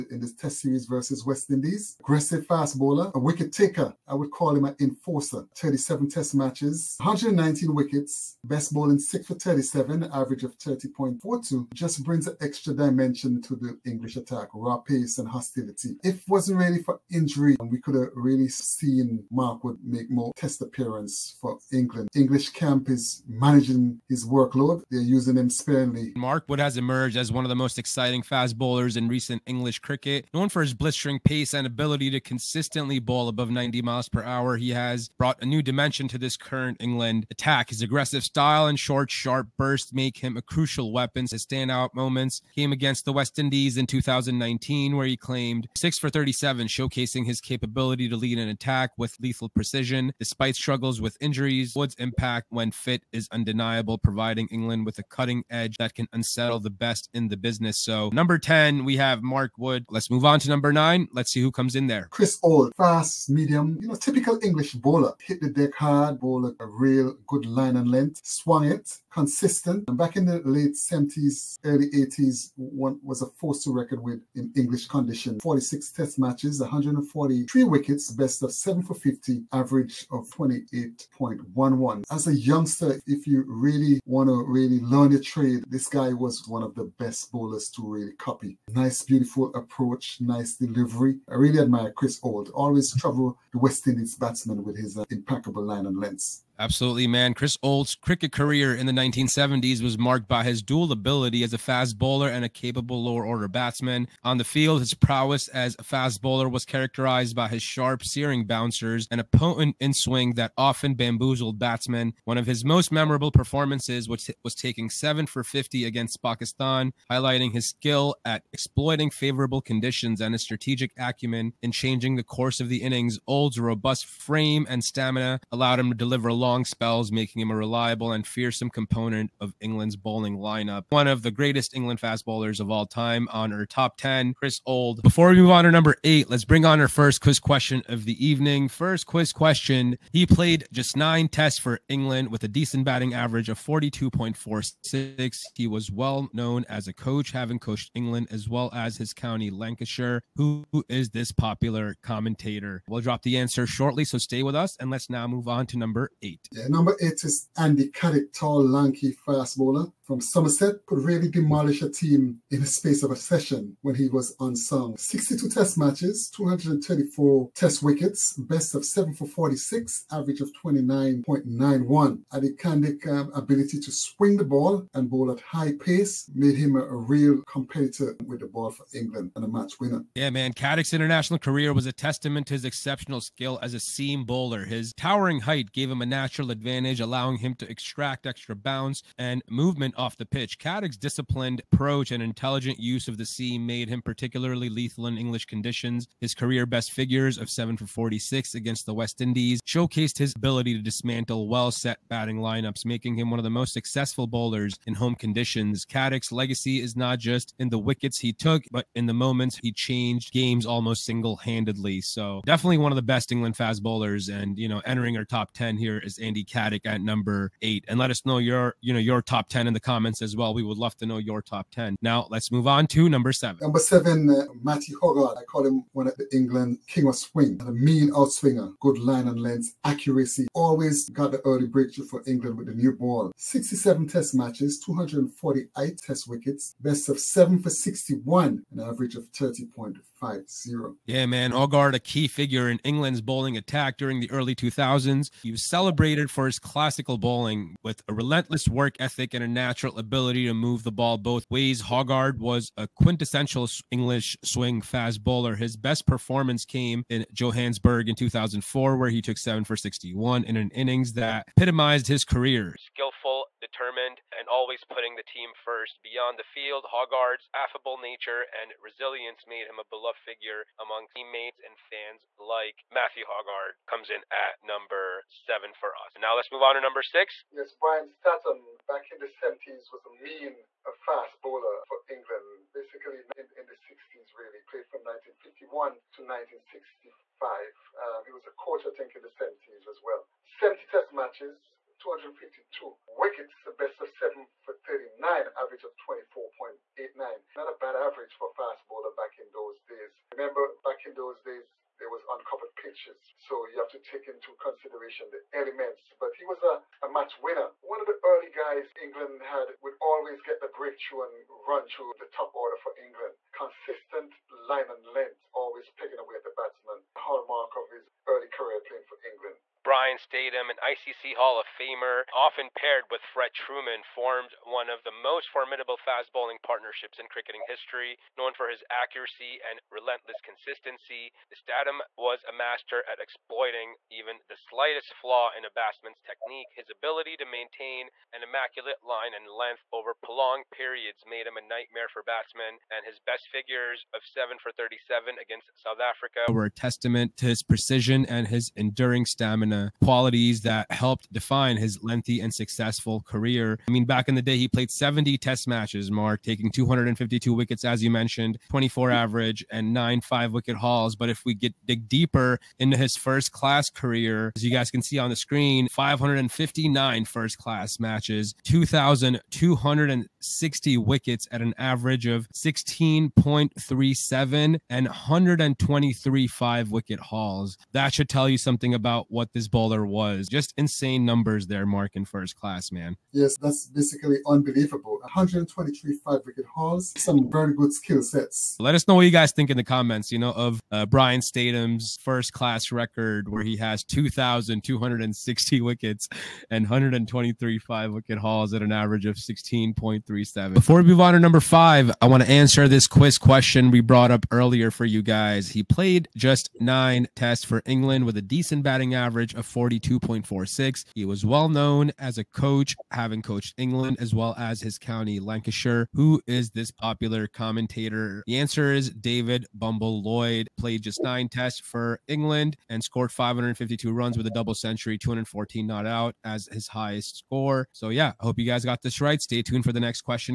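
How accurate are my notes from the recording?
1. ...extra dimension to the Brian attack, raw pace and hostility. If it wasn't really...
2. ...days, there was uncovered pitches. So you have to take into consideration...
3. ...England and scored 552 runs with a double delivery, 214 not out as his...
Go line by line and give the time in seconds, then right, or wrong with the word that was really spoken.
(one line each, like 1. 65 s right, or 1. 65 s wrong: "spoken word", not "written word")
1. 12 s wrong: "English", not "Brian"
2. 301 s right
3. 422 s wrong: "century", not "delivery".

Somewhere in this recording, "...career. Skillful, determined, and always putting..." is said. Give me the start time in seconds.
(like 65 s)
262 s.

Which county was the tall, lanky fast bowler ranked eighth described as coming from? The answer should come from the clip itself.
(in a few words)
Somerset.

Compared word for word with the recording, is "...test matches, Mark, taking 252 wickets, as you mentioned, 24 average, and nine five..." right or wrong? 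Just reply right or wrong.
right.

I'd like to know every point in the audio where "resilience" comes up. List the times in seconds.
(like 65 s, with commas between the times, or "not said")
268 s.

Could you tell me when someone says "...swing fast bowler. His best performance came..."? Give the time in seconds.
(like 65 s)
254 s.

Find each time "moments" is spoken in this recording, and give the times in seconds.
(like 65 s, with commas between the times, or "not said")
41 s, 209 s.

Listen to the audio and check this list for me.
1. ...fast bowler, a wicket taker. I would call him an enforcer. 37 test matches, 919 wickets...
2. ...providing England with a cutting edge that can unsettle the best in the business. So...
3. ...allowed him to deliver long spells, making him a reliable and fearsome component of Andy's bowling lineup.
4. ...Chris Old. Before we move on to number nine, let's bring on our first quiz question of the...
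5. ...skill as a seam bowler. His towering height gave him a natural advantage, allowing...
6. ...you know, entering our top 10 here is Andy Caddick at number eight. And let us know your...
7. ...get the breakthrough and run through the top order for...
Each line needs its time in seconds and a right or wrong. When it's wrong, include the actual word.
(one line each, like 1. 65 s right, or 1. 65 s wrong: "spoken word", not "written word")
1. 2 s wrong: "119", not "919"
2. 53 s right
3. 125 s wrong: "England", not "Andy"
4. 134 s wrong: "eight", not "nine"
5. 183 s right
6. 214 s right
7. 310 s right.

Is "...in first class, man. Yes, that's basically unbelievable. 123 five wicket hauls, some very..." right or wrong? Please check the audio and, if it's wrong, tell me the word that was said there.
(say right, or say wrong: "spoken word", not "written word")
right.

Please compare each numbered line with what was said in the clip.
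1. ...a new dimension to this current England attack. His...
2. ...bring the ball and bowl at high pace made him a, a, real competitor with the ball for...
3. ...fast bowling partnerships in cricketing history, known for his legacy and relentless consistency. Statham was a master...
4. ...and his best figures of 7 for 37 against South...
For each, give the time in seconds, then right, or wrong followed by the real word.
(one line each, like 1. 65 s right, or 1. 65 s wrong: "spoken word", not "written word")
1. 35 s right
2. 173 s wrong: "swing", not "bring"
3. 325 s wrong: "accuracy", not "legacy"
4. 342 s right.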